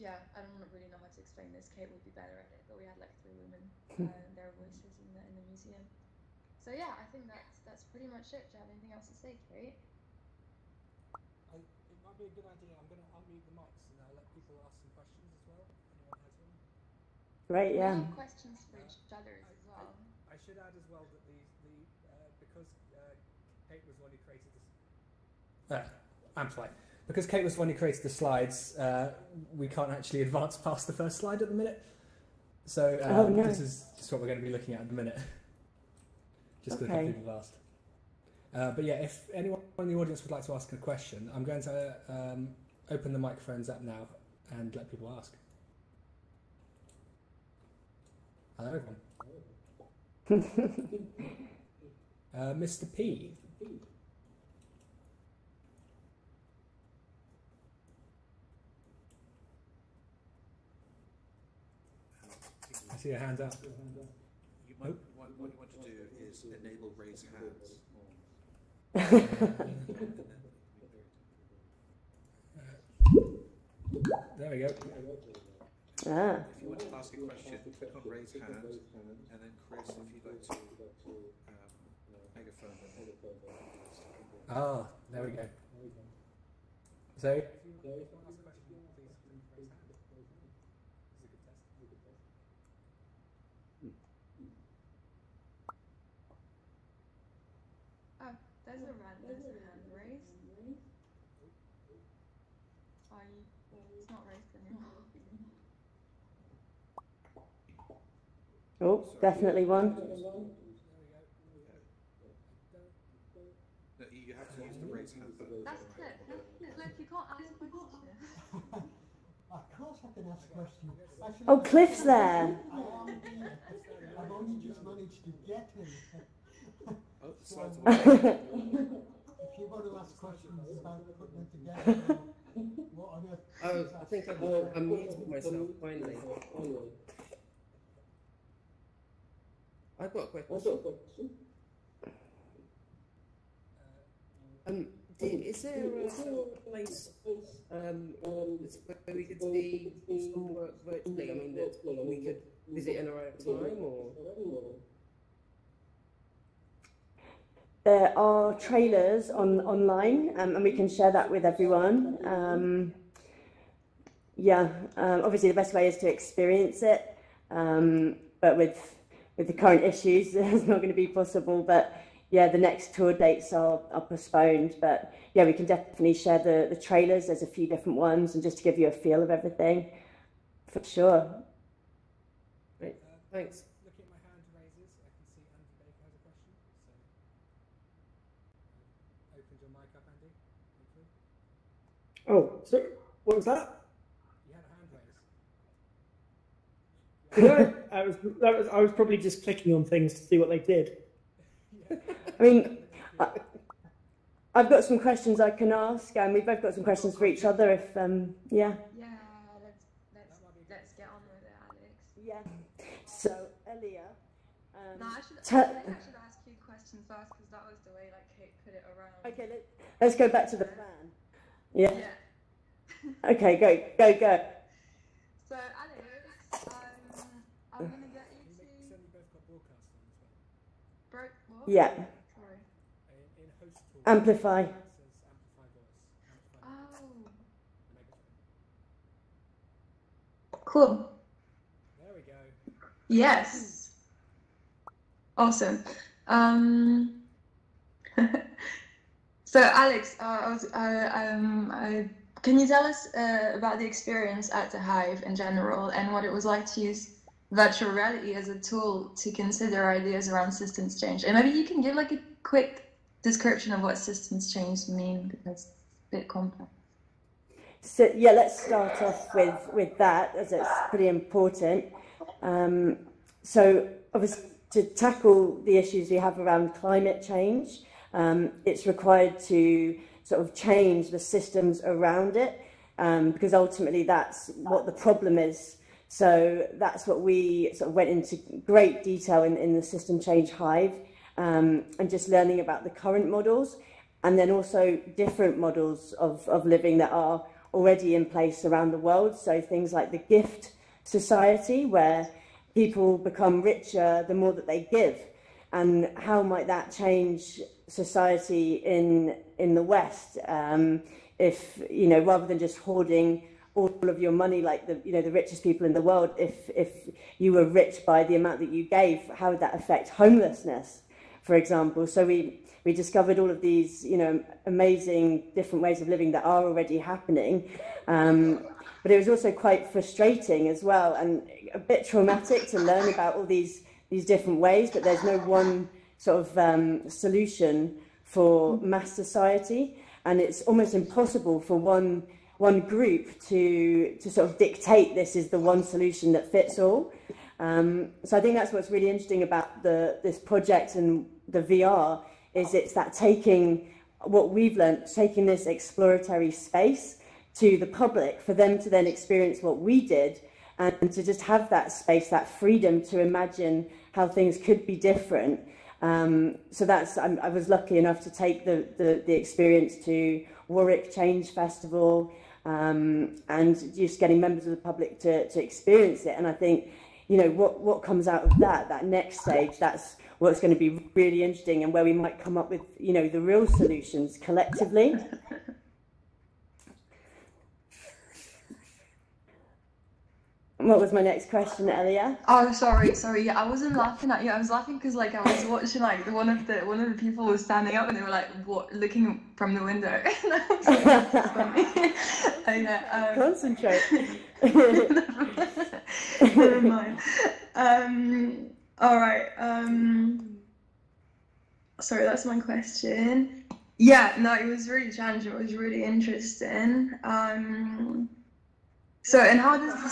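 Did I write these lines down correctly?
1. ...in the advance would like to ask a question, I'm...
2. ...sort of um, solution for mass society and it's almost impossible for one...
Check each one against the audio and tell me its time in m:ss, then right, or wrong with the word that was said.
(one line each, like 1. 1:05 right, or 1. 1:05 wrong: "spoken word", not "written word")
1. 0:39 wrong: "audience", not "advance"
2. 5:36 right.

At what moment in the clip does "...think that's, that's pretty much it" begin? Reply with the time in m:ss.
0:07.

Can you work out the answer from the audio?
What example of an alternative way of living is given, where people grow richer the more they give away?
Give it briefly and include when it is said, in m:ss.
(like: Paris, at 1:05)
gift society, at 5:00.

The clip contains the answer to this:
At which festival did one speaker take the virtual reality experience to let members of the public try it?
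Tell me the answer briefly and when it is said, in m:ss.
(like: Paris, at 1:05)
Warwick Change Festival, at 6:10.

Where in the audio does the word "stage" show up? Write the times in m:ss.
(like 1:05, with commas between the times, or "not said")
6:19.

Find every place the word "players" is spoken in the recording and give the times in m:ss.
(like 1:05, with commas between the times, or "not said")
not said.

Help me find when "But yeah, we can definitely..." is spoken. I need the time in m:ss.
2:54.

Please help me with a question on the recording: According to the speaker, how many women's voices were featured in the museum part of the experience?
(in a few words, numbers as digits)
3.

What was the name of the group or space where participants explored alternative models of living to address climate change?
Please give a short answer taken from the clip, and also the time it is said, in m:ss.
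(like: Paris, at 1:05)
System Change Hive, at 4:49.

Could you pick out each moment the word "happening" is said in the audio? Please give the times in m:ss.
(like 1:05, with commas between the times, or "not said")
5:26.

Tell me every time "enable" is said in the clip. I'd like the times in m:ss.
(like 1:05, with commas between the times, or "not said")
1:06.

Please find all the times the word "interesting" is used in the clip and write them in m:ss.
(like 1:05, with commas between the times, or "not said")
5:49, 6:21, 6:56.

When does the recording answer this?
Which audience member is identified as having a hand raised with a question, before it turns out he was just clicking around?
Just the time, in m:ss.
3:05.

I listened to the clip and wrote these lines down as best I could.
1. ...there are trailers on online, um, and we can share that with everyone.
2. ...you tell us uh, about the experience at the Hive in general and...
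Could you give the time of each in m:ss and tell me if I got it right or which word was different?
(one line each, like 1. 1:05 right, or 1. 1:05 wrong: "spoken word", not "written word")
1. 2:37 right
2. 4:12 right.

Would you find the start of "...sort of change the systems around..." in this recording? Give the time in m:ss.
4:40.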